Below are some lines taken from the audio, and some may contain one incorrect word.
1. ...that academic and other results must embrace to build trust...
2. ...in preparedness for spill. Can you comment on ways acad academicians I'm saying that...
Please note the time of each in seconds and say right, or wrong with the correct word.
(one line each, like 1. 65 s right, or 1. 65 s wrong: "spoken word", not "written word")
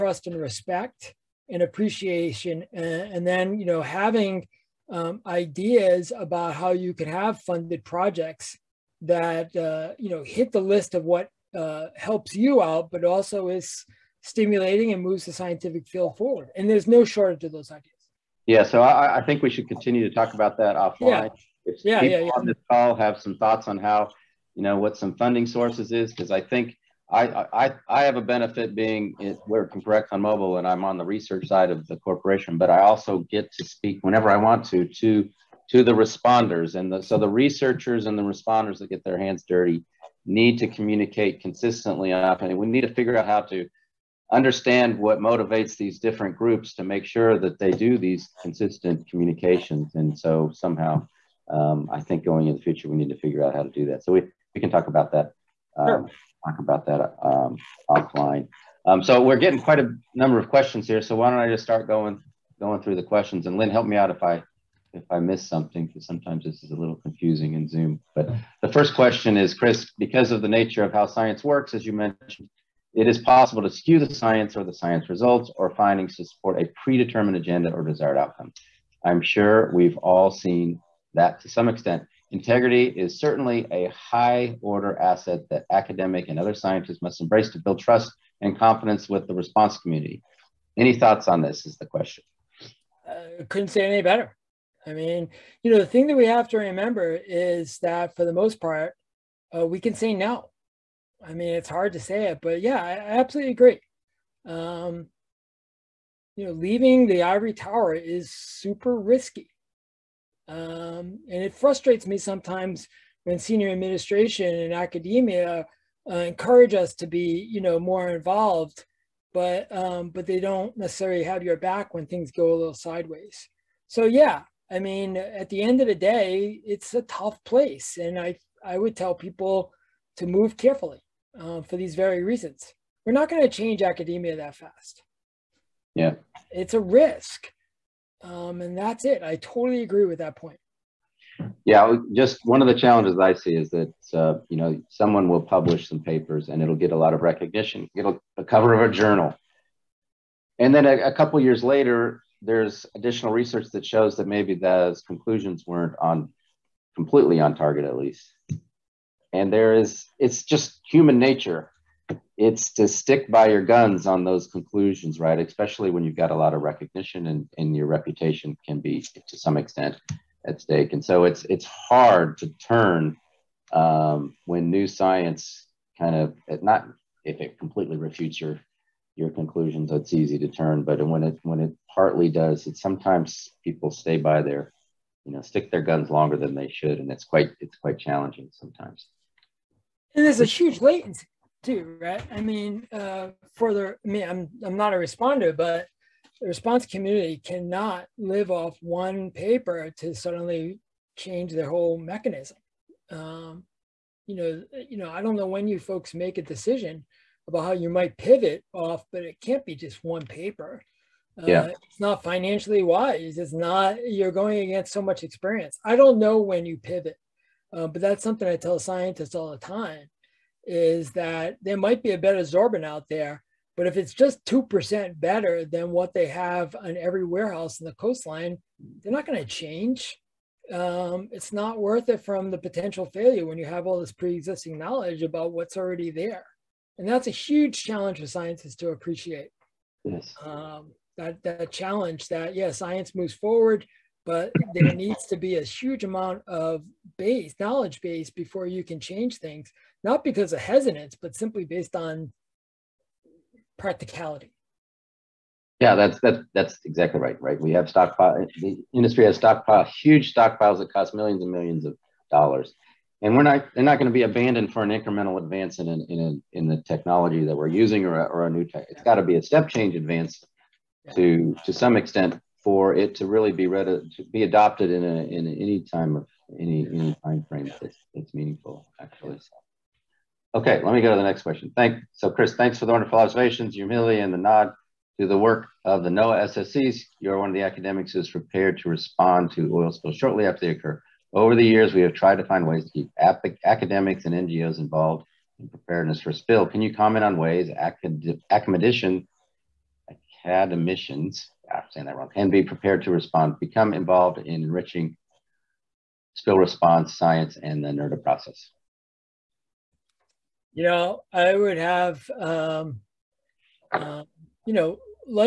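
1. 85 s wrong: "scientists", not "results"
2. 295 s right.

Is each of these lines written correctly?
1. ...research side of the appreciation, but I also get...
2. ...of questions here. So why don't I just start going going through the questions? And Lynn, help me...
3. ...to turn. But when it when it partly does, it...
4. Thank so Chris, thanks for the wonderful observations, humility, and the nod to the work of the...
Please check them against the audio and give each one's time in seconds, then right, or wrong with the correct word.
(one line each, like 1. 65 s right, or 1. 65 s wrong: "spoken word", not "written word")
1. 31 s wrong: "corporation", not "appreciation"
2. 60 s right
3. 180 s right
4. 281 s right.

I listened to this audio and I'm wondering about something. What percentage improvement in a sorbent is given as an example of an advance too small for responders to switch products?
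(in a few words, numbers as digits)
2%.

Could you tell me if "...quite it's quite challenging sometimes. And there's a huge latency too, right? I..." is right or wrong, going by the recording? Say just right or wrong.
right.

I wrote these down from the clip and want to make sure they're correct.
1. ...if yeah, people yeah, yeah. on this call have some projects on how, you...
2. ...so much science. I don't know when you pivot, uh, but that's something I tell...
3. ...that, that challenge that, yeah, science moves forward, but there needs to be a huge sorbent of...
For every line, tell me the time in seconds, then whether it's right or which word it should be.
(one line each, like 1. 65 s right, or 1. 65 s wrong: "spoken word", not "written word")
1. 21 s wrong: "thoughts", not "projects"
2. 214 s wrong: "experience", not "science"
3. 241 s wrong: "amount", not "sorbent".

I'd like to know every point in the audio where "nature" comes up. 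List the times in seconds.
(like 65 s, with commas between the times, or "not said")
70 s, 161 s.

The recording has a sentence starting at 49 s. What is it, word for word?
And so somehow um, I think going in the future, we need to figure out how to do that.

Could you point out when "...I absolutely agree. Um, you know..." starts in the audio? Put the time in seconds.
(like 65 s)
102 s.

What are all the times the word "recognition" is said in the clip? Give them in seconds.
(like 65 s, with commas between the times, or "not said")
147 s, 166 s.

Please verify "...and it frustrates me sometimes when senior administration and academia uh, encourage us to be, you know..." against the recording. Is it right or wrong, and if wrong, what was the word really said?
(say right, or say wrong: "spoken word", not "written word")
right.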